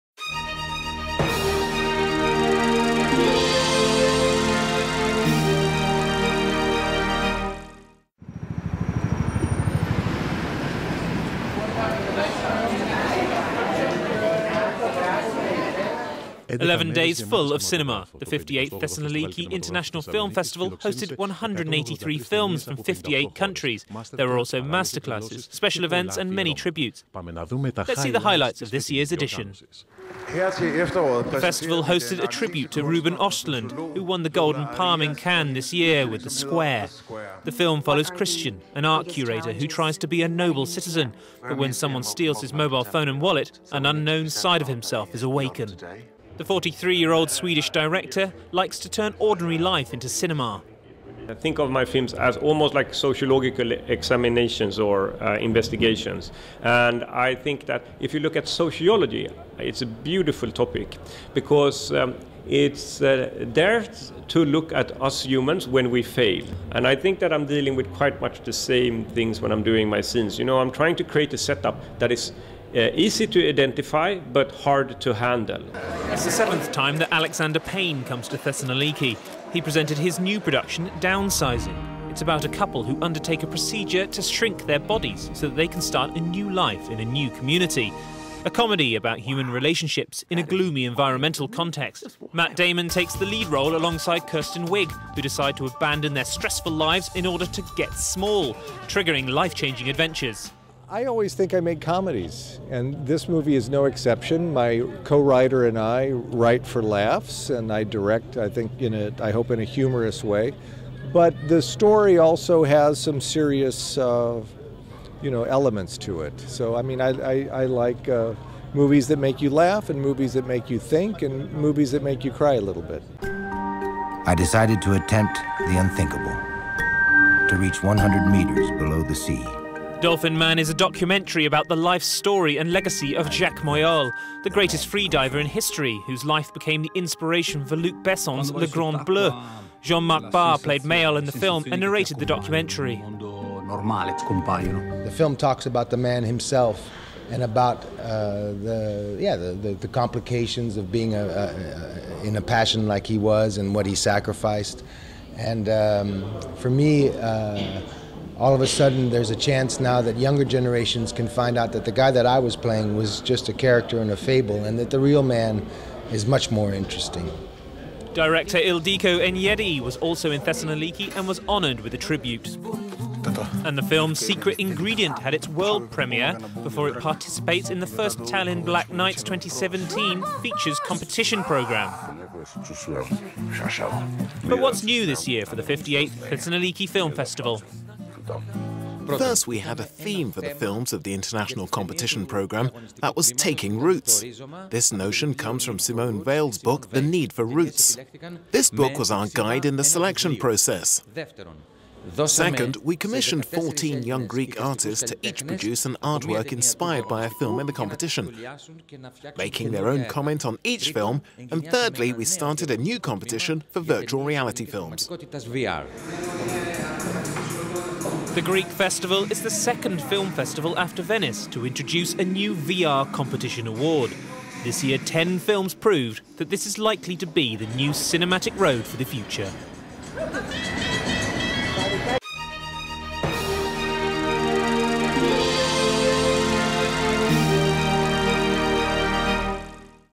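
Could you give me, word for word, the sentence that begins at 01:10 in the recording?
You know, I'm trying to create a setup that is uh, easy to identify but hard to handle.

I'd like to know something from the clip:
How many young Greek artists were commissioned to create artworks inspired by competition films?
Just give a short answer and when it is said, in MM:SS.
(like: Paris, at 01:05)
14, at 03:23.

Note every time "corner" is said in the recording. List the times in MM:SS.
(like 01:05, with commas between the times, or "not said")
not said.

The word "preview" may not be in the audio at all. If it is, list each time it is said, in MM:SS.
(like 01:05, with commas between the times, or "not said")
not said.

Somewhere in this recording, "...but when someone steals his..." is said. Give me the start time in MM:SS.
00:41.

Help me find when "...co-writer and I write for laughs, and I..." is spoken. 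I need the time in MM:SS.
01:45.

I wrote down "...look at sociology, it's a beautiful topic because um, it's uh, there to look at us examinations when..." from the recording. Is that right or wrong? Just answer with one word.
wrong.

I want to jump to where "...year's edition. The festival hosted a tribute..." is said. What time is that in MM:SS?
00:28.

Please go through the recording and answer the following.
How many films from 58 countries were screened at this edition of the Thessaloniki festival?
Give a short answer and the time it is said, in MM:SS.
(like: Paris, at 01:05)
183, at 00:21.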